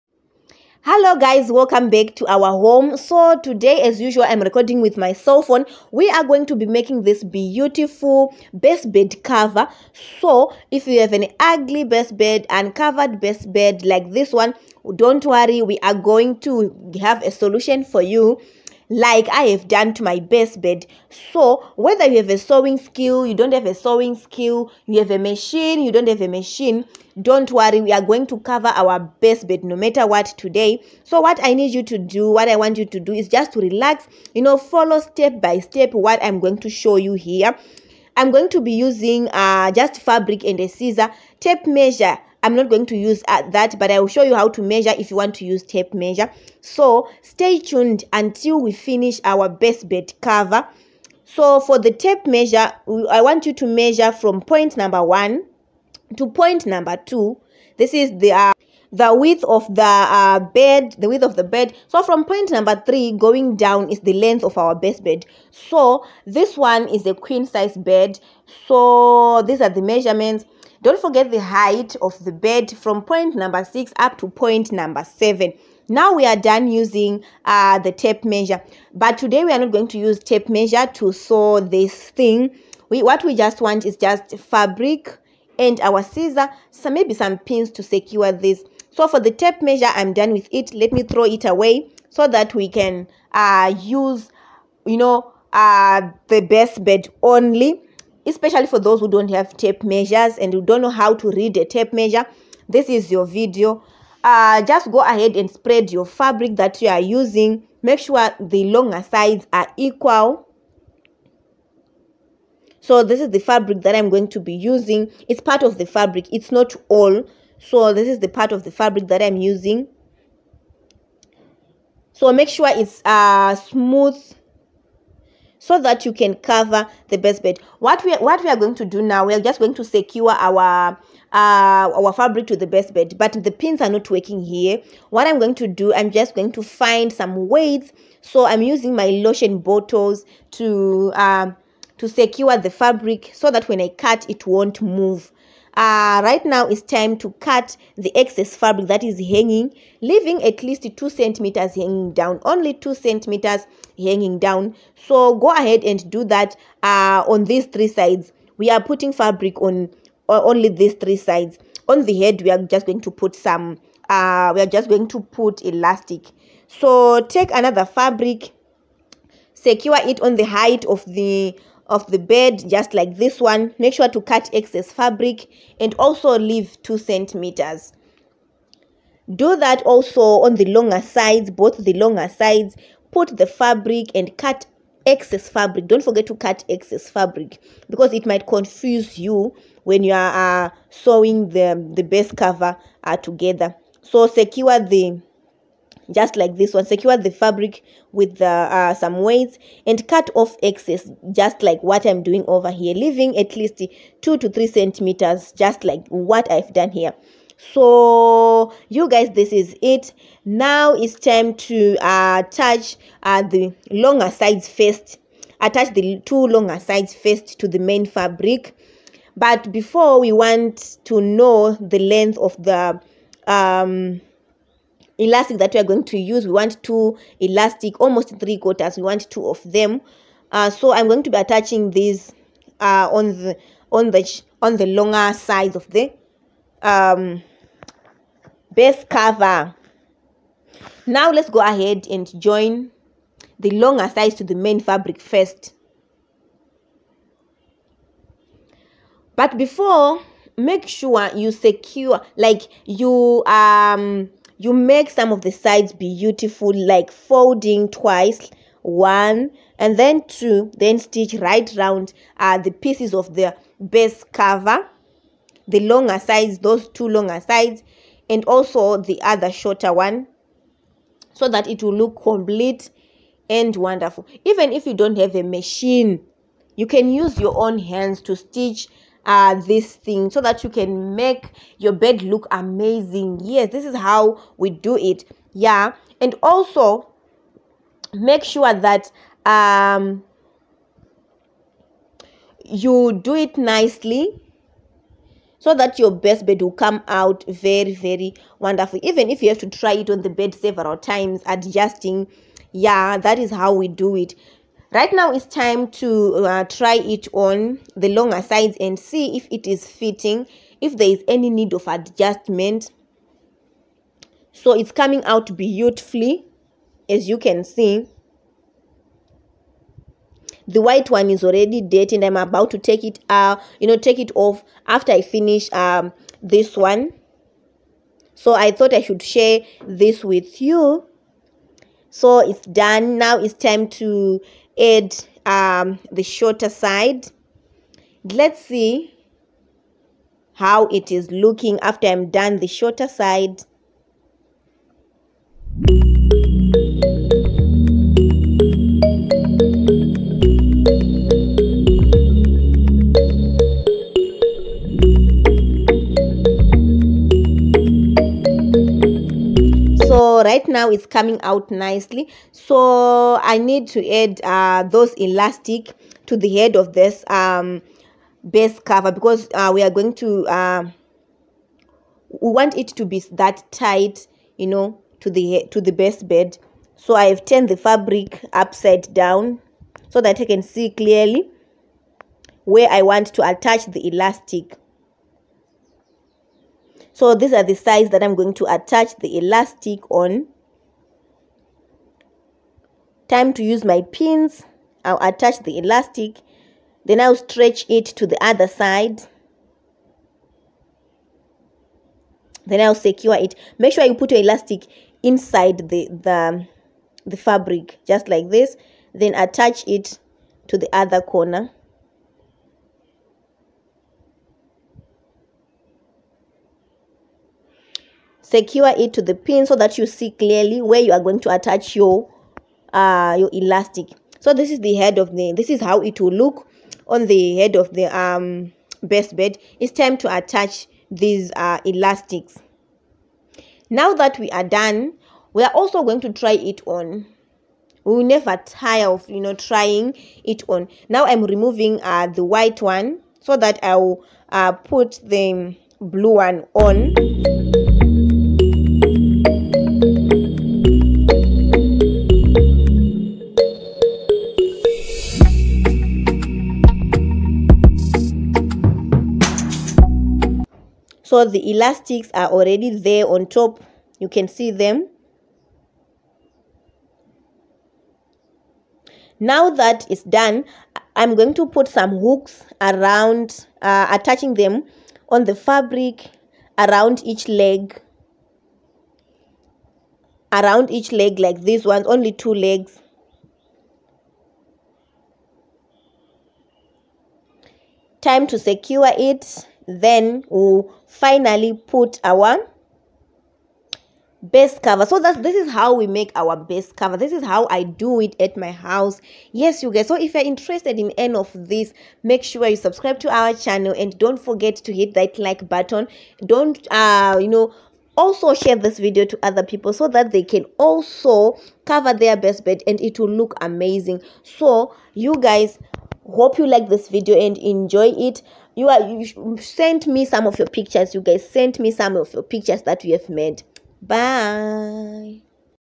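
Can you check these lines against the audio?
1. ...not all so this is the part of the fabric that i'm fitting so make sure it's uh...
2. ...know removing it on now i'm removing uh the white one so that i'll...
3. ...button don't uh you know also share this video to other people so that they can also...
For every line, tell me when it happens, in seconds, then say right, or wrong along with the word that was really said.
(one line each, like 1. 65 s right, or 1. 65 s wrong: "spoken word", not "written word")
1. 116 s wrong: "using", not "fitting"
2. 439 s wrong: "trying", not "removing"
3. 505 s right.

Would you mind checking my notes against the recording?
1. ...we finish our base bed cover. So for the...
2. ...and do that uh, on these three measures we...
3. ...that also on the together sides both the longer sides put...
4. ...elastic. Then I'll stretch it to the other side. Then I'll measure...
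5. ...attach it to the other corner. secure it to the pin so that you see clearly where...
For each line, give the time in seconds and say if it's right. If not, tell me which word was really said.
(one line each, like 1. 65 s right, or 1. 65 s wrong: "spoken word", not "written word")
1. 48 s right
2. 155 s wrong: "sides", not "measures"
3. 179 s wrong: "longer", not "together"
4. 395 s wrong: "secure", not "measure"
5. 409 s right.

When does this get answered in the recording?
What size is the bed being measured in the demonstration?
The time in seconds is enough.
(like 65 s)
67 s.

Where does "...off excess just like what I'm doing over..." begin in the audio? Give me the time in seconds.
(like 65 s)
200 s.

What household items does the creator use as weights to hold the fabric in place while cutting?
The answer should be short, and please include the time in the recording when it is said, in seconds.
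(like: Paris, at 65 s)
lotion bottles, at 139 s.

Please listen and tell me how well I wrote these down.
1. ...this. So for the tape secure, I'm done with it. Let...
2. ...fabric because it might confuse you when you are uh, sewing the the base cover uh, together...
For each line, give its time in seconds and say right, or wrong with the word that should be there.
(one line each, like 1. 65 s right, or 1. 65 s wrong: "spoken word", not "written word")
1. 88 s wrong: "measure", not "secure"
2. 187 s right.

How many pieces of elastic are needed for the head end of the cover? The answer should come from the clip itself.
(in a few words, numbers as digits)
2.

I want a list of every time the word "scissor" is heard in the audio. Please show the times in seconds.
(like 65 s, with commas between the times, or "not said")
40 s, 86 s.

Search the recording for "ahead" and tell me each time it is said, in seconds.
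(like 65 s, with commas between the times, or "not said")
104 s, 155 s, 241 s.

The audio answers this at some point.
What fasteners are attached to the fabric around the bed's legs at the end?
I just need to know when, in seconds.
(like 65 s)
472 s.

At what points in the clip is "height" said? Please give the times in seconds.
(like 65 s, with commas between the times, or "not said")
71 s, 170 s.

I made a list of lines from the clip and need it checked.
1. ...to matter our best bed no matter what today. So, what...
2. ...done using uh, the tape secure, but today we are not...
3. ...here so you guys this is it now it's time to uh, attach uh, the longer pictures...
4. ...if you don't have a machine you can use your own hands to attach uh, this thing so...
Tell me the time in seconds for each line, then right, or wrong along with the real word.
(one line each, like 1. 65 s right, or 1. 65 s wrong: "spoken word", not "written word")
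1. 28 s wrong: "cover", not "matter"
2. 76 s wrong: "measure", not "secure"
3. 206 s wrong: "sides", not "pictures"
4. 274 s wrong: "stitch", not "attach".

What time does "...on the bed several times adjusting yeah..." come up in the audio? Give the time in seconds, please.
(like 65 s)
300 s.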